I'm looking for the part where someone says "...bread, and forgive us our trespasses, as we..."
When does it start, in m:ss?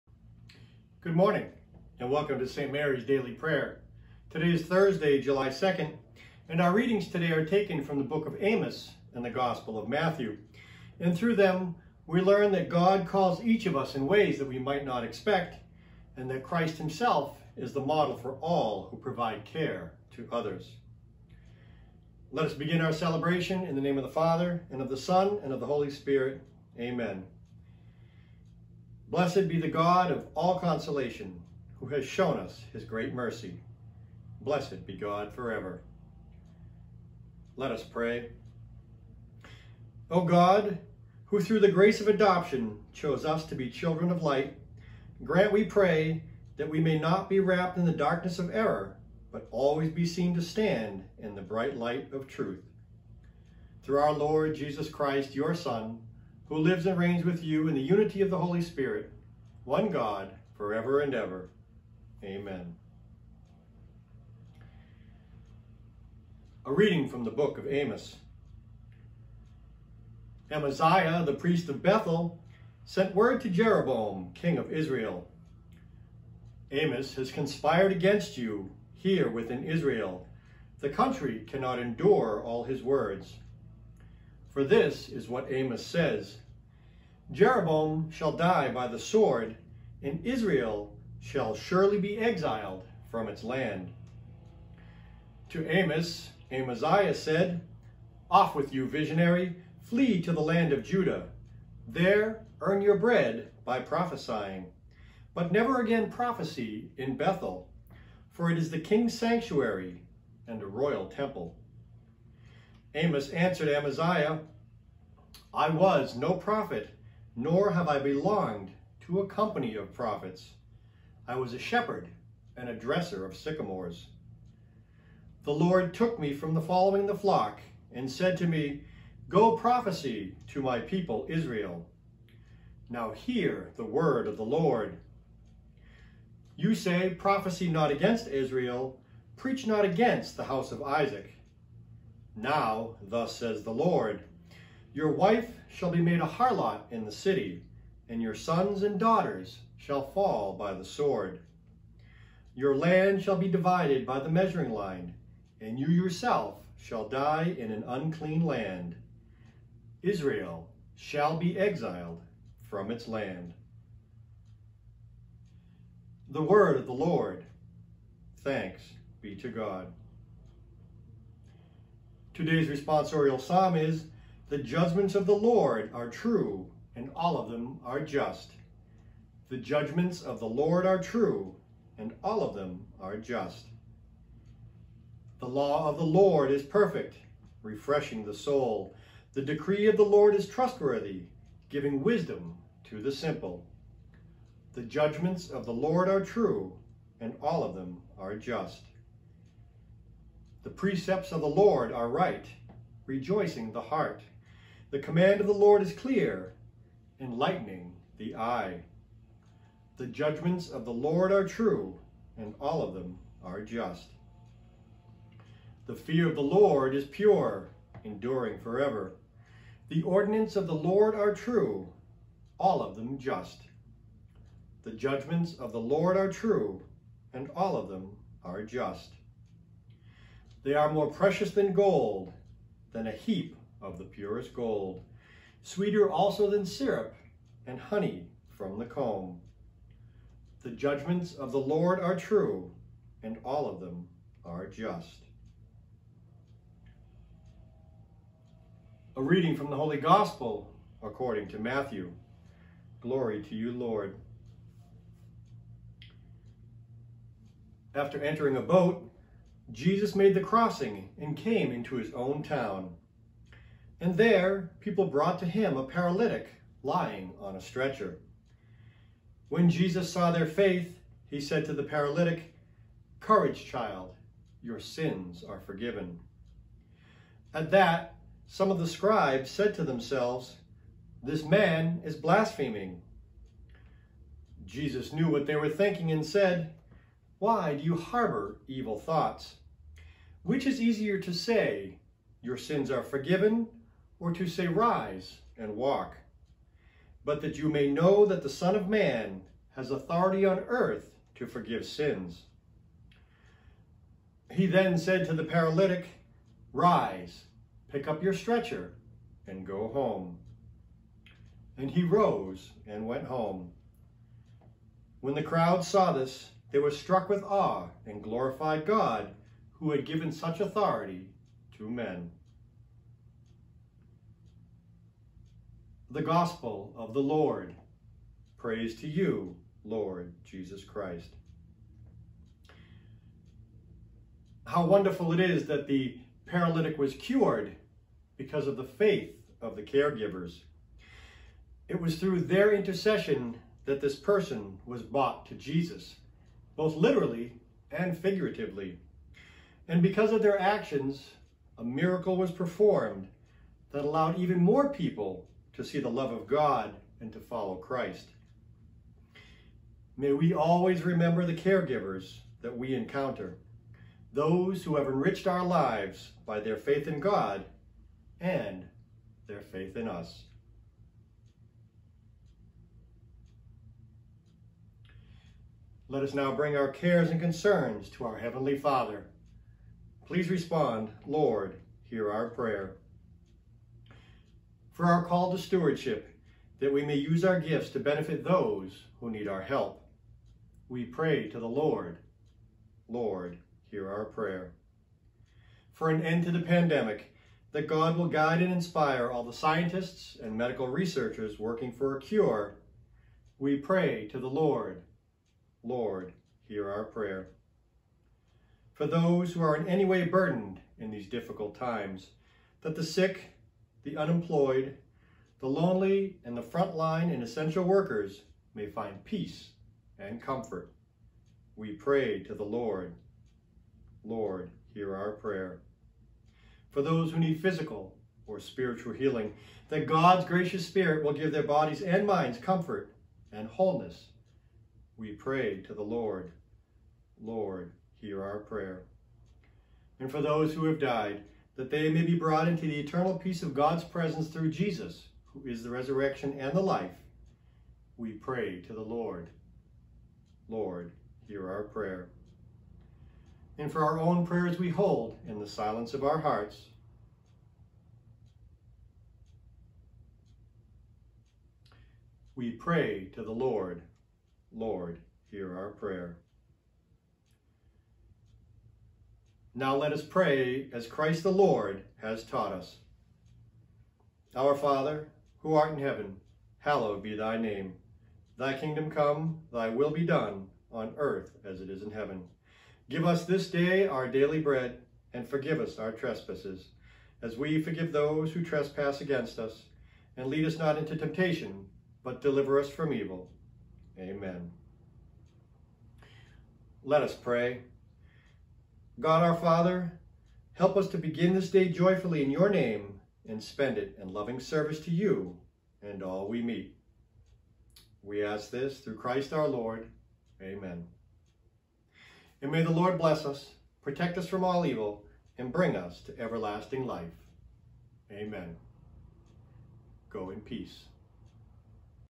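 8:04.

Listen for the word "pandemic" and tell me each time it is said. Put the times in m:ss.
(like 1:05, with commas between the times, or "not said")
6:36.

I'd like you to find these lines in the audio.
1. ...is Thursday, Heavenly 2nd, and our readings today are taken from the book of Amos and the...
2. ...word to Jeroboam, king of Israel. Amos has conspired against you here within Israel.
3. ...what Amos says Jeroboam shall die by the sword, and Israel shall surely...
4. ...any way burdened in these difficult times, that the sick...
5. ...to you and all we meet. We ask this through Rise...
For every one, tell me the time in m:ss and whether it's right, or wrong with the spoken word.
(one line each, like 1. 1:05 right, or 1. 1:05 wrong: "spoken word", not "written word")
1. 0:04 wrong: "July", not "Heavenly"
2. 1:13 right
3. 1:25 right
4. 6:49 right
5. 8:25 wrong: "Christ", not "Rise".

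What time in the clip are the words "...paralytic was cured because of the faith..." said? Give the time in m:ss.
5:36.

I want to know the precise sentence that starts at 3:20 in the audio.
The precepts of the Lord are right, rejoicing the heart.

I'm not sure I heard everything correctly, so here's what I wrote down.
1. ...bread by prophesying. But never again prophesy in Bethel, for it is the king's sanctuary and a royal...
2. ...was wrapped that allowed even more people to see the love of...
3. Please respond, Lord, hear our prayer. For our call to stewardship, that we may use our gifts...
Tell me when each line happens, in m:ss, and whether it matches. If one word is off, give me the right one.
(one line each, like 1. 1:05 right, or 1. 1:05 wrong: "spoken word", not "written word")
1. 1:42 right
2. 5:52 wrong: "performed", not "wrapped"
3. 6:20 right.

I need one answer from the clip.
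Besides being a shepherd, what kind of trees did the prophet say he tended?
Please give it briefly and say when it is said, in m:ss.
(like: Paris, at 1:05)
sycamores, at 2:03.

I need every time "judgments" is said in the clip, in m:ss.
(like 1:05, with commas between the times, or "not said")
2:54, 2:59, 3:14, 3:30, 3:44, 4:00.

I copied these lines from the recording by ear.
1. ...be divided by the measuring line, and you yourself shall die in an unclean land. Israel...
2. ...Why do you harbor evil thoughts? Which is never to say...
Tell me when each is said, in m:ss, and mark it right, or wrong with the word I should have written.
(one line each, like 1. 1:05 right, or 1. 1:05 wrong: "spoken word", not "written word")
1. 2:33 right
2. 4:47 wrong: "easier", not "never".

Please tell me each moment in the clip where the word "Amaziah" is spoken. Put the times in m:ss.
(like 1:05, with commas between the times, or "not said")
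1:10, 1:36, 1:53.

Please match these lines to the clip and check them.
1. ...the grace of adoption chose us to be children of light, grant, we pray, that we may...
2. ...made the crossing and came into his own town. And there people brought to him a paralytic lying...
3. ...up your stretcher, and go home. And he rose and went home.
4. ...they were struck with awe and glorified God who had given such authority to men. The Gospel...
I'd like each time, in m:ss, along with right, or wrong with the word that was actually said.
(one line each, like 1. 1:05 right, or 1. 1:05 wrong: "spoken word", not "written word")
1. 0:41 right
2. 4:20 right
3. 5:08 right
4. 5:16 right.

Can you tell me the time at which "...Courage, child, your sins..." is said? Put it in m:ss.
4:33.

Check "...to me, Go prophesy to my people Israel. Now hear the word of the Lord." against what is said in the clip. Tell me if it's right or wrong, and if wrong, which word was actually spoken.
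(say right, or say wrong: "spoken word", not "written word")
right.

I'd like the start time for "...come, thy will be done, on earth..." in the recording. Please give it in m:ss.
7:59.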